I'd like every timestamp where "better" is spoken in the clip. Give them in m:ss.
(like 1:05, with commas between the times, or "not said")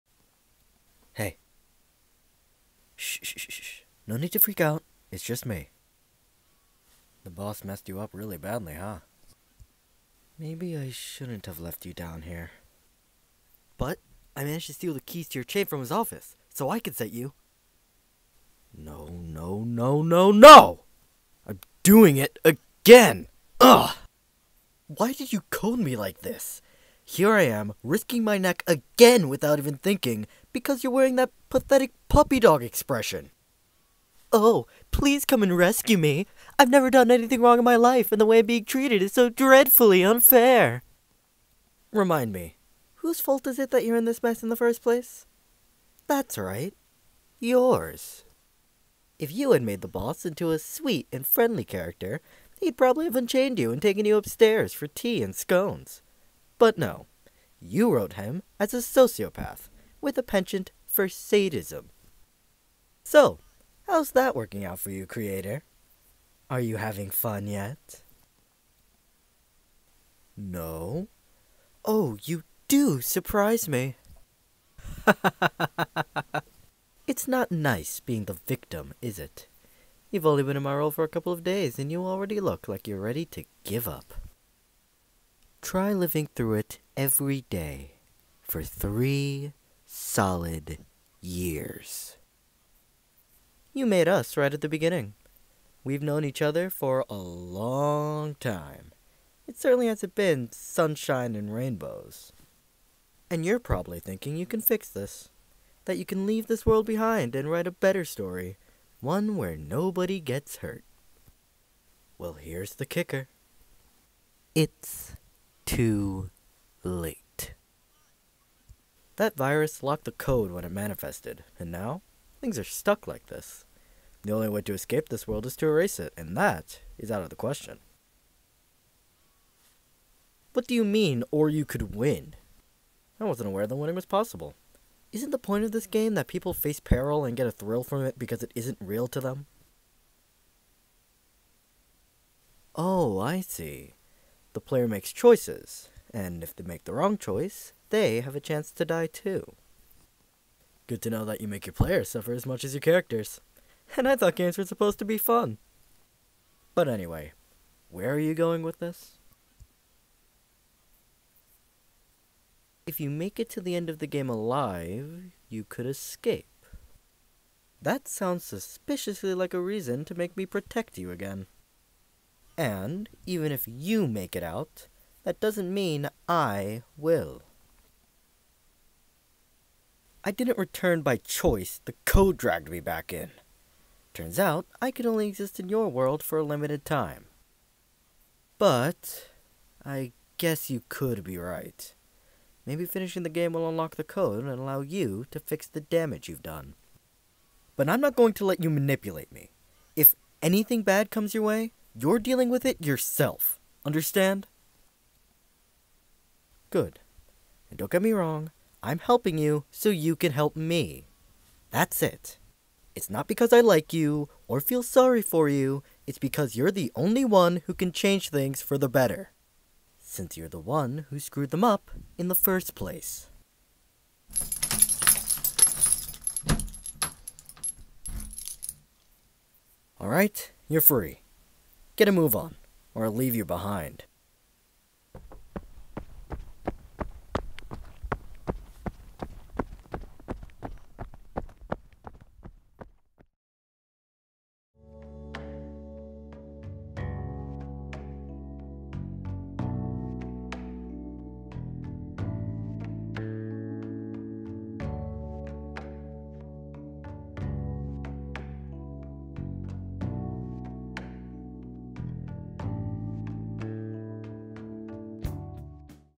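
1:47, 3:38.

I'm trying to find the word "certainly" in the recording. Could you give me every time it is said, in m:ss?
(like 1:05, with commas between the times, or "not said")
1:39.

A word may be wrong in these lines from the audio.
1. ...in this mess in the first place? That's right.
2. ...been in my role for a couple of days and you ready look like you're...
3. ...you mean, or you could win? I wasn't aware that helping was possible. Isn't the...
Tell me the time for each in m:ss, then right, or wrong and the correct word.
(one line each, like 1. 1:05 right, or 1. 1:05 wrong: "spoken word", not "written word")
1. 0:43 right
2. 1:20 wrong: "already", not "ready"
3. 2:10 wrong: "winning", not "helping".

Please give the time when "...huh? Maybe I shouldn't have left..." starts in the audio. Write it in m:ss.
0:08.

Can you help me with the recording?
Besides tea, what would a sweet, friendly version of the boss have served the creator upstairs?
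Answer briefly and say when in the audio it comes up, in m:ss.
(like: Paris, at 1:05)
Scones, at 0:55.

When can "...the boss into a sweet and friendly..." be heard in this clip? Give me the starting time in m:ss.
0:49.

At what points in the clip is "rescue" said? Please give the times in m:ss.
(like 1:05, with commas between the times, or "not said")
0:35.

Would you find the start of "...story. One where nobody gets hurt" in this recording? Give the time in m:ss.
1:48.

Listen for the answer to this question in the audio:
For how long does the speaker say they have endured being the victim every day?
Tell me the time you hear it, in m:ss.
1:28.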